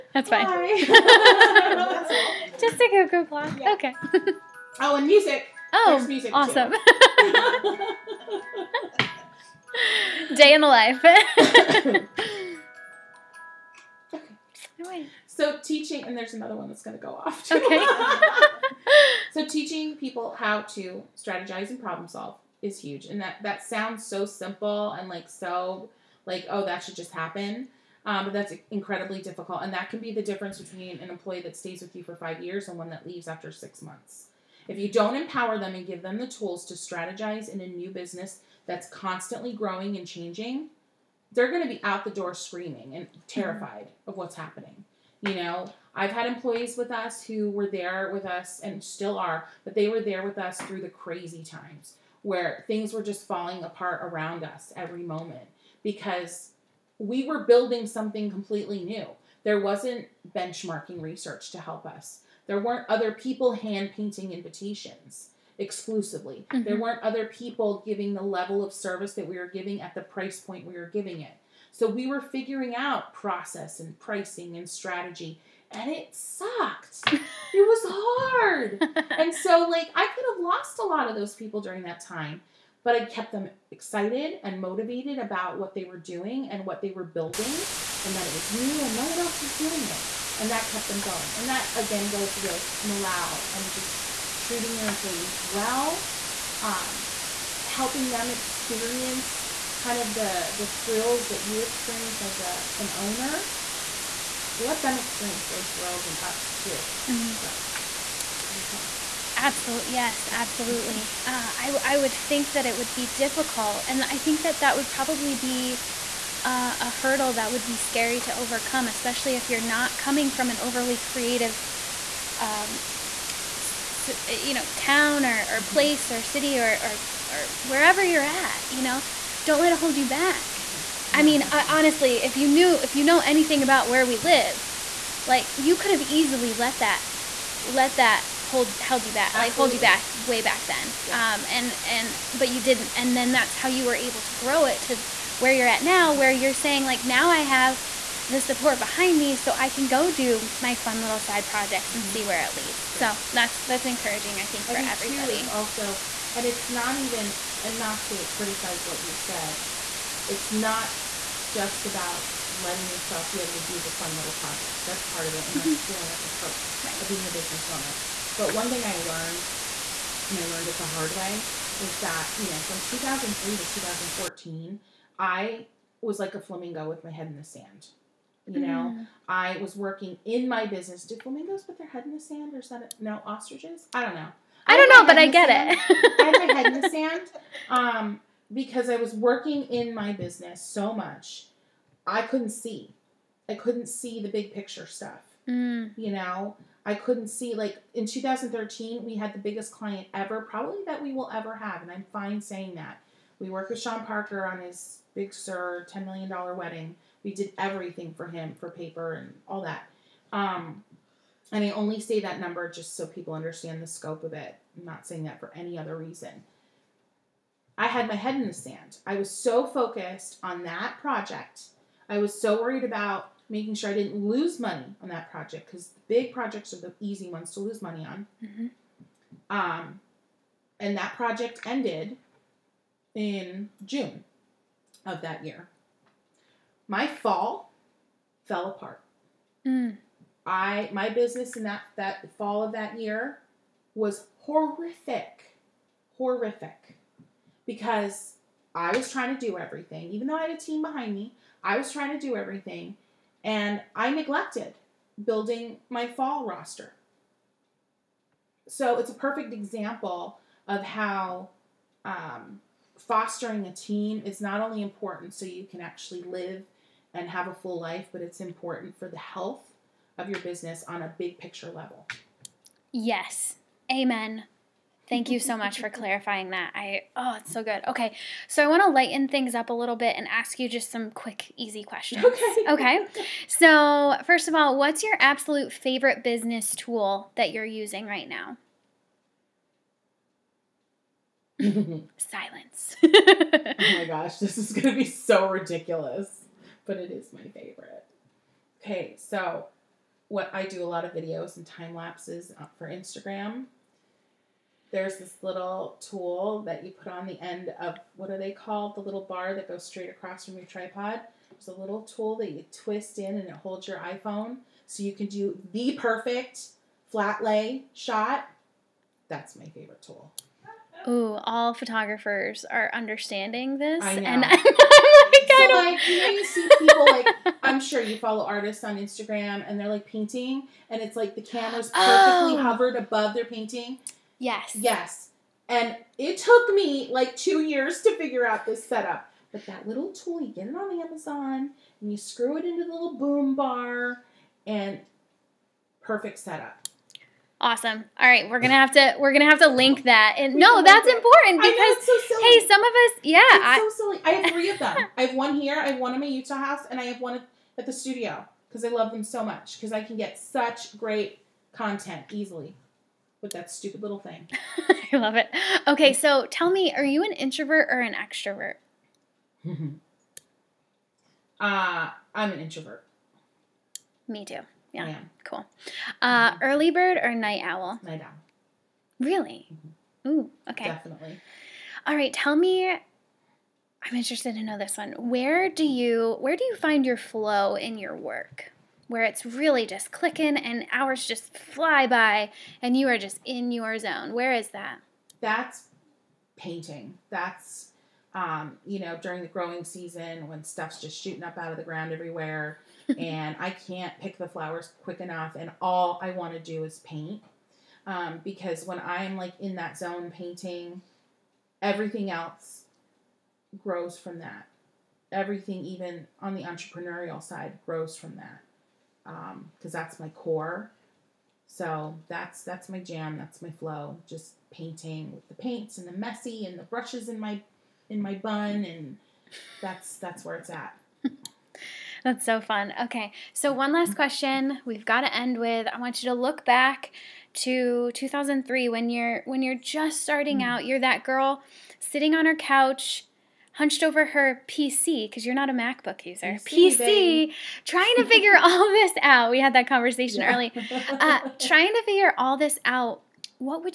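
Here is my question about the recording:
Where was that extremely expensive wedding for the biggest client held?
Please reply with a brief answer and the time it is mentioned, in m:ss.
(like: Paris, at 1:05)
Big Sur, at 3:25.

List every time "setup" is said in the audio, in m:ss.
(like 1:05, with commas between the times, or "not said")
5:38, 5:46.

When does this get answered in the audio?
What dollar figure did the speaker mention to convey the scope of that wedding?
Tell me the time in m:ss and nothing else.
3:25.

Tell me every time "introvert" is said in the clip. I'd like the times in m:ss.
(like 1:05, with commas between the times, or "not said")
6:07, 6:12.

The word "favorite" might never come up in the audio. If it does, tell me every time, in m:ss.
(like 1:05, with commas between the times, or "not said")
4:45, 4:57, 5:19.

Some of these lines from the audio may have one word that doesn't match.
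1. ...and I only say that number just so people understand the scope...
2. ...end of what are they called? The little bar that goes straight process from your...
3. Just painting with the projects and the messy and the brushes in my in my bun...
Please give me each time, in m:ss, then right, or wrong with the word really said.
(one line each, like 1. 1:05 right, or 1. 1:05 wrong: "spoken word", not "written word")
1. 3:31 right
2. 5:07 wrong: "across", not "process"
3. 7:04 wrong: "paints", not "projects".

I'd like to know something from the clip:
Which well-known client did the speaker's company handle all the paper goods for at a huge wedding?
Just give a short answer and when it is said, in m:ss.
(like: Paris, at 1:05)
Sean Parker, at 3:23.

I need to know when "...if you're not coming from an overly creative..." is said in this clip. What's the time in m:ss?
1:59.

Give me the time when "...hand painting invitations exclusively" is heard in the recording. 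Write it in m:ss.
1:03.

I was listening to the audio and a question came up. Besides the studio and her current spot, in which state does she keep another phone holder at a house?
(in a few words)
Utah.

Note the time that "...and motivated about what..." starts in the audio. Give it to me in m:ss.
1:24.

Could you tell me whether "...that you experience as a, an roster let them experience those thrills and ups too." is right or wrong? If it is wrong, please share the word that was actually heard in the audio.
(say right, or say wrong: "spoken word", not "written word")
wrong: "owner", not "roster".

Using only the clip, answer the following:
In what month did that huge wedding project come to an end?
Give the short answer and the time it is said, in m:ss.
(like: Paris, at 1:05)
June, at 3:53.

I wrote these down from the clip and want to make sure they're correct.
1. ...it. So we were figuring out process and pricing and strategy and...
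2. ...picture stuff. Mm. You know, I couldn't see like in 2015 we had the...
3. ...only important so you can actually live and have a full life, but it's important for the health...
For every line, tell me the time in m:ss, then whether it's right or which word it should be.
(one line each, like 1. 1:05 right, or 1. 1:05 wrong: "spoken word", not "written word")
1. 1:11 right
2. 3:14 wrong: "2013", not "2015"
3. 4:24 right.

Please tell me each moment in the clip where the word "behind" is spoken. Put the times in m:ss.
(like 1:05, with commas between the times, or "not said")
2:28, 4:10.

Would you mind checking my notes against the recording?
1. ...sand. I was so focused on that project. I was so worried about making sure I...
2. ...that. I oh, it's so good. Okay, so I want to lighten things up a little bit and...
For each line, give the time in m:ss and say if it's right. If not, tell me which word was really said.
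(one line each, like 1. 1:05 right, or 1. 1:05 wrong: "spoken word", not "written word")
1. 3:38 right
2. 4:36 right.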